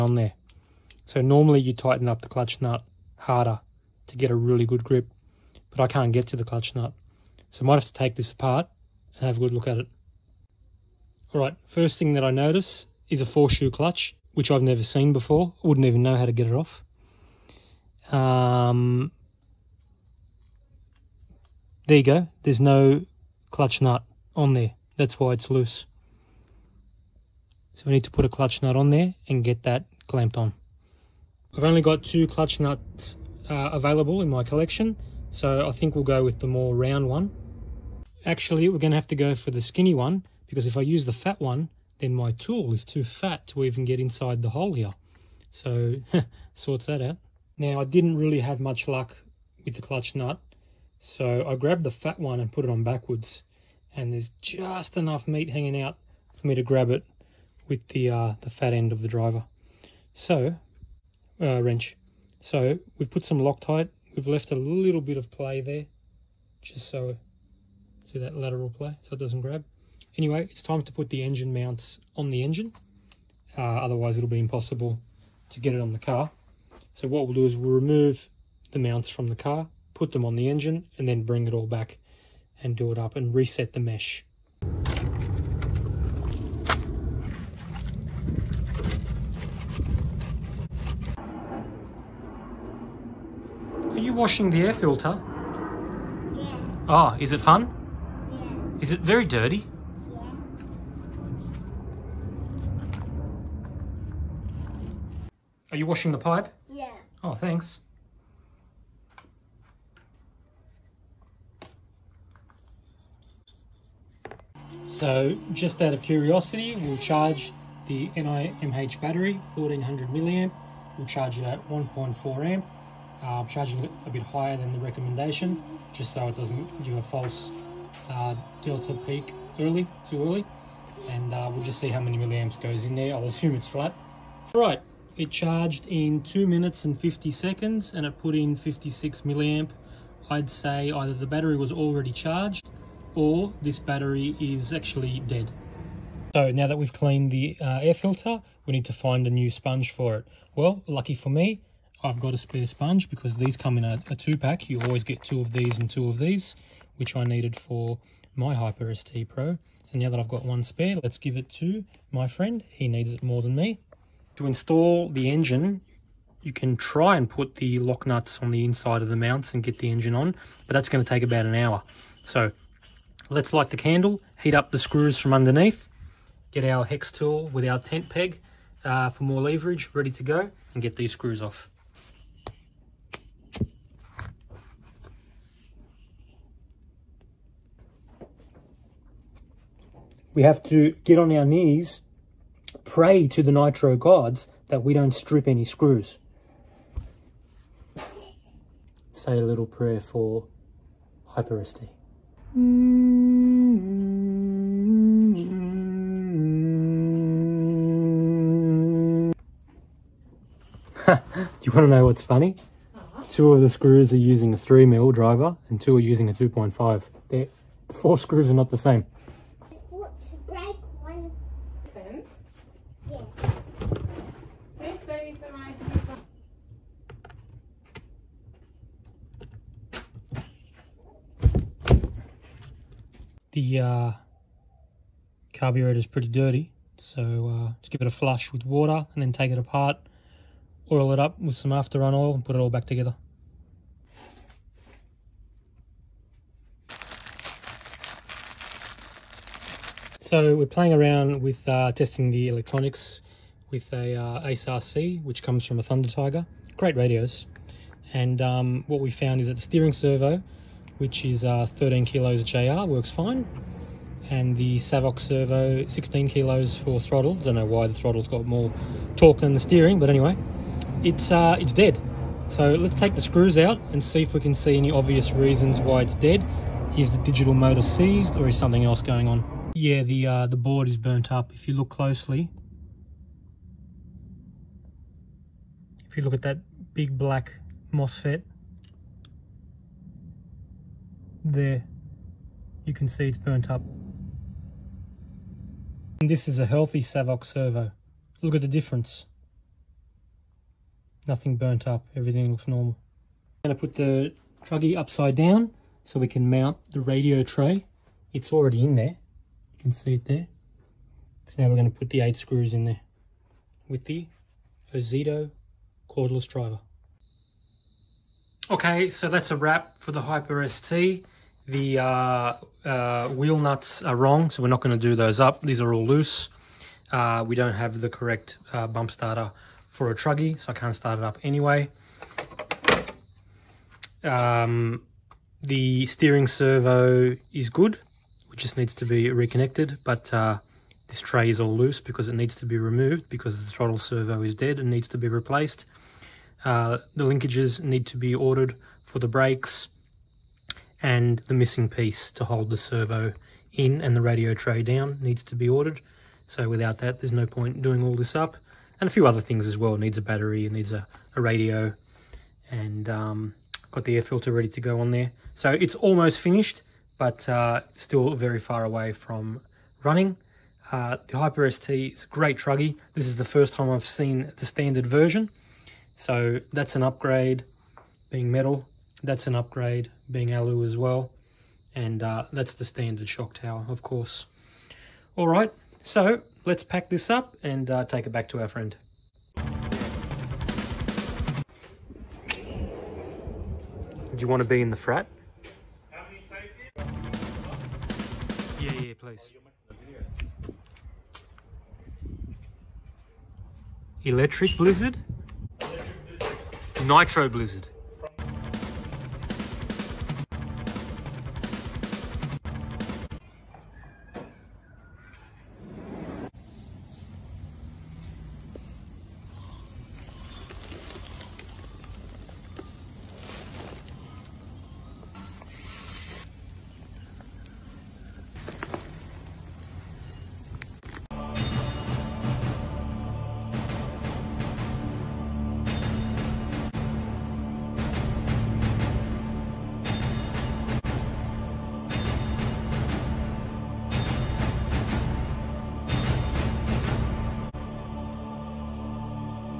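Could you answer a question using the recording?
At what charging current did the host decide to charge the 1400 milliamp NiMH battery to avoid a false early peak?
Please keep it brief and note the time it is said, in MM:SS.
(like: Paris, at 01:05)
1.4 amp, at 02:01.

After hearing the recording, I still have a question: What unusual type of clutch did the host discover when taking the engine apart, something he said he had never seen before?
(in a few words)
four shoe clutch.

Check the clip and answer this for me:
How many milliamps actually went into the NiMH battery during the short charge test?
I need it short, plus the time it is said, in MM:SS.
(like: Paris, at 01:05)
56 milliamp, at 02:18.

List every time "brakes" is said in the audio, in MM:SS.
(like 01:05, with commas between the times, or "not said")
05:49.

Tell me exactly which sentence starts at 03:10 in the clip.
We have to get on our knees, pray to the nitro gods that we don't strip any screws.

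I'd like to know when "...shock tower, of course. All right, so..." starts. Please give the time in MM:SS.
06:23.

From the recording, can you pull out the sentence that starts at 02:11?
And uh, we'll just see how many milliamps goes in there.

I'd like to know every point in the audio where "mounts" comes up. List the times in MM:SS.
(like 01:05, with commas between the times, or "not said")
01:11, 01:18, 02:49, 05:06.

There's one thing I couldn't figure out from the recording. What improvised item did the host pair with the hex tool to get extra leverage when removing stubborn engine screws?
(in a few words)
tent peg.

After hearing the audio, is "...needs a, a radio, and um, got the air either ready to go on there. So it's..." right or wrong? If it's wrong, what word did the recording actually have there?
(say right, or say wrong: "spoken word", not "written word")
wrong: "filter", not "either".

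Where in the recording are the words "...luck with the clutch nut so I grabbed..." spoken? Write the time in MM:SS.
00:48.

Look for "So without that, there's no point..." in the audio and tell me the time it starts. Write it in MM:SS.
05:56.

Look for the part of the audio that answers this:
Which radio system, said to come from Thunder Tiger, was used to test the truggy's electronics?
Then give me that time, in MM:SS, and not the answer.
04:14.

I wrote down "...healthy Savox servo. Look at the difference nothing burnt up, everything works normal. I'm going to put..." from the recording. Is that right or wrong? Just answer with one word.
wrong.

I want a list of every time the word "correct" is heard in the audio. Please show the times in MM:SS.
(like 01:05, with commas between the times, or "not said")
05:28.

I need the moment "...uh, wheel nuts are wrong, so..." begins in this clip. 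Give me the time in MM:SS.
05:22.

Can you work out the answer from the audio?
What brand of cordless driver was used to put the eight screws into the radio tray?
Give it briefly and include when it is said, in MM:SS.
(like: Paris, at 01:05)
Ozito, at 05:14.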